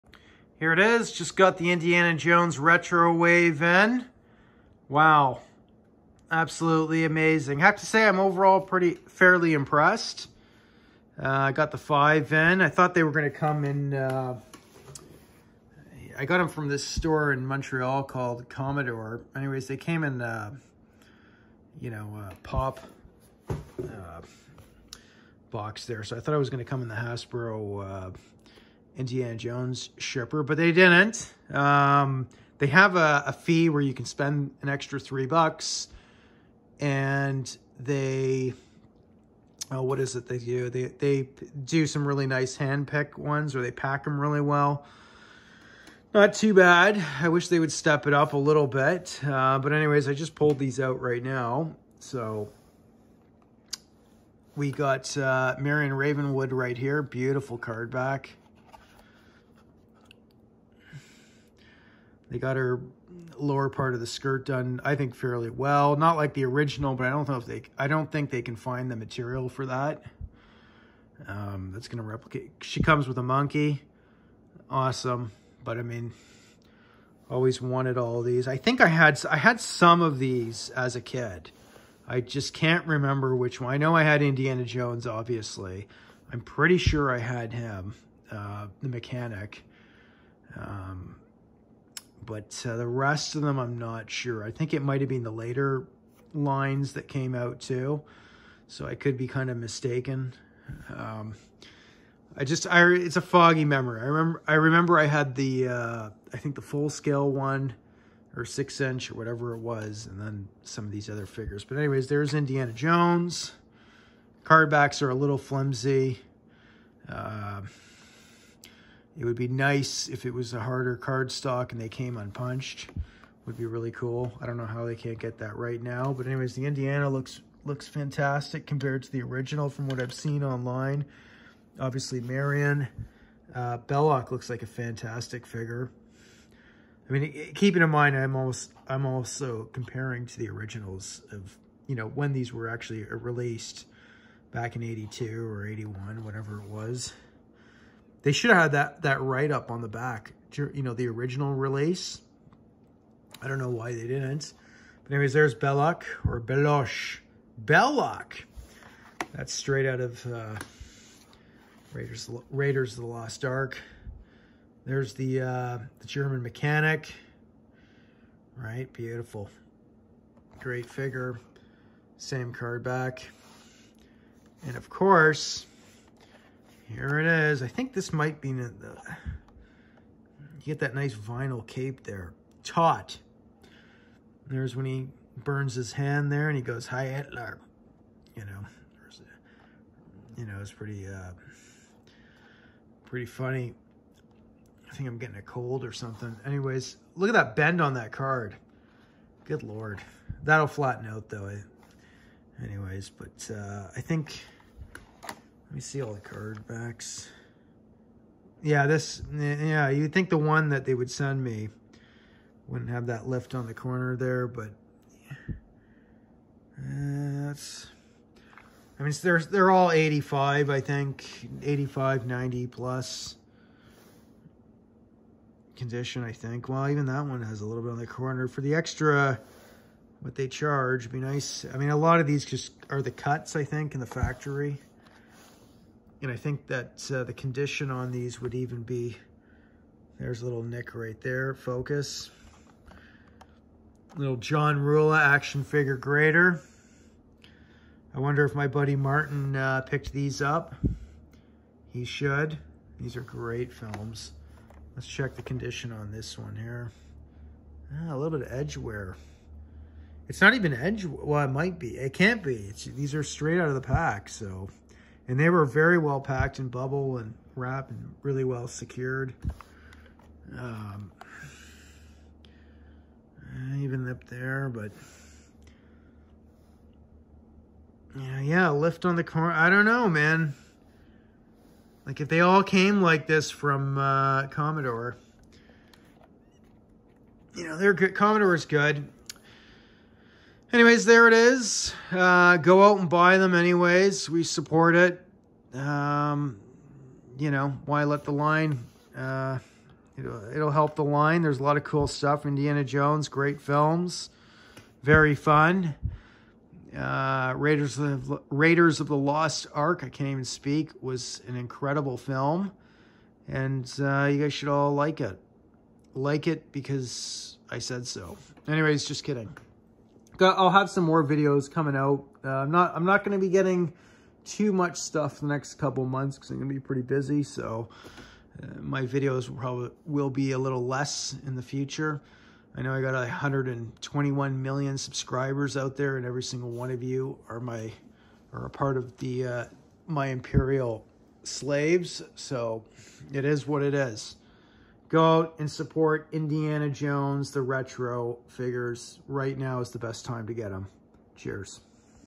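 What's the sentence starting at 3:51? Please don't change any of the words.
I mean, a lot of these just are the cuts, I think, in the factory.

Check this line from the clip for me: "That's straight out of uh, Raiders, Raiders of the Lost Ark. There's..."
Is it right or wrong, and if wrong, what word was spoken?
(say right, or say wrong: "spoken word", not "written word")
right.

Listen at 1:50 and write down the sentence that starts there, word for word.
And then some of these other figures, but anyways, there's Indiana Jones.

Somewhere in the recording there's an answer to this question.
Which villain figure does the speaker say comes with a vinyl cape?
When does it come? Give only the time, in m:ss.
3:02.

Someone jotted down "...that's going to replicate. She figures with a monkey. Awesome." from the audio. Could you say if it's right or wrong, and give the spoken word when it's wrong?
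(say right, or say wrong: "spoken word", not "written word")
wrong: "comes", not "figures".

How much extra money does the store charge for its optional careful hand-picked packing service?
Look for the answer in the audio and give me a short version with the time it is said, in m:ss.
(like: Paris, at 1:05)
3 bucks, at 0:34.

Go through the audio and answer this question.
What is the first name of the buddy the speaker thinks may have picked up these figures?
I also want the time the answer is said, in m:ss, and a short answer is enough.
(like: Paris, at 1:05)
Martin, at 4:08.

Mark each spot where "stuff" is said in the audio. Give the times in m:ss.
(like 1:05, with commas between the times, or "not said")
5:02, 5:24.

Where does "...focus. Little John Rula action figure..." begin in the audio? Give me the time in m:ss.
4:01.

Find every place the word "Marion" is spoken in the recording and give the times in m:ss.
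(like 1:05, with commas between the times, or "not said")
0:55, 2:12.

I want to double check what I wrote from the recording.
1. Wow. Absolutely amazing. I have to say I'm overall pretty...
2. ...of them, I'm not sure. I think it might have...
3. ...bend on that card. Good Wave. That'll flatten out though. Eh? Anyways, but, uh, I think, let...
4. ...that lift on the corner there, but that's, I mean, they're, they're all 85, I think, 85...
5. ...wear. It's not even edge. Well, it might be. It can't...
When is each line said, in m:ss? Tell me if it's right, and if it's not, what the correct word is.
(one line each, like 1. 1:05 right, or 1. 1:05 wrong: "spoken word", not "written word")
1. 0:04 right
2. 1:33 right
3. 3:17 wrong: "Lord", not "Wave"
4. 3:33 right
5. 4:18 right.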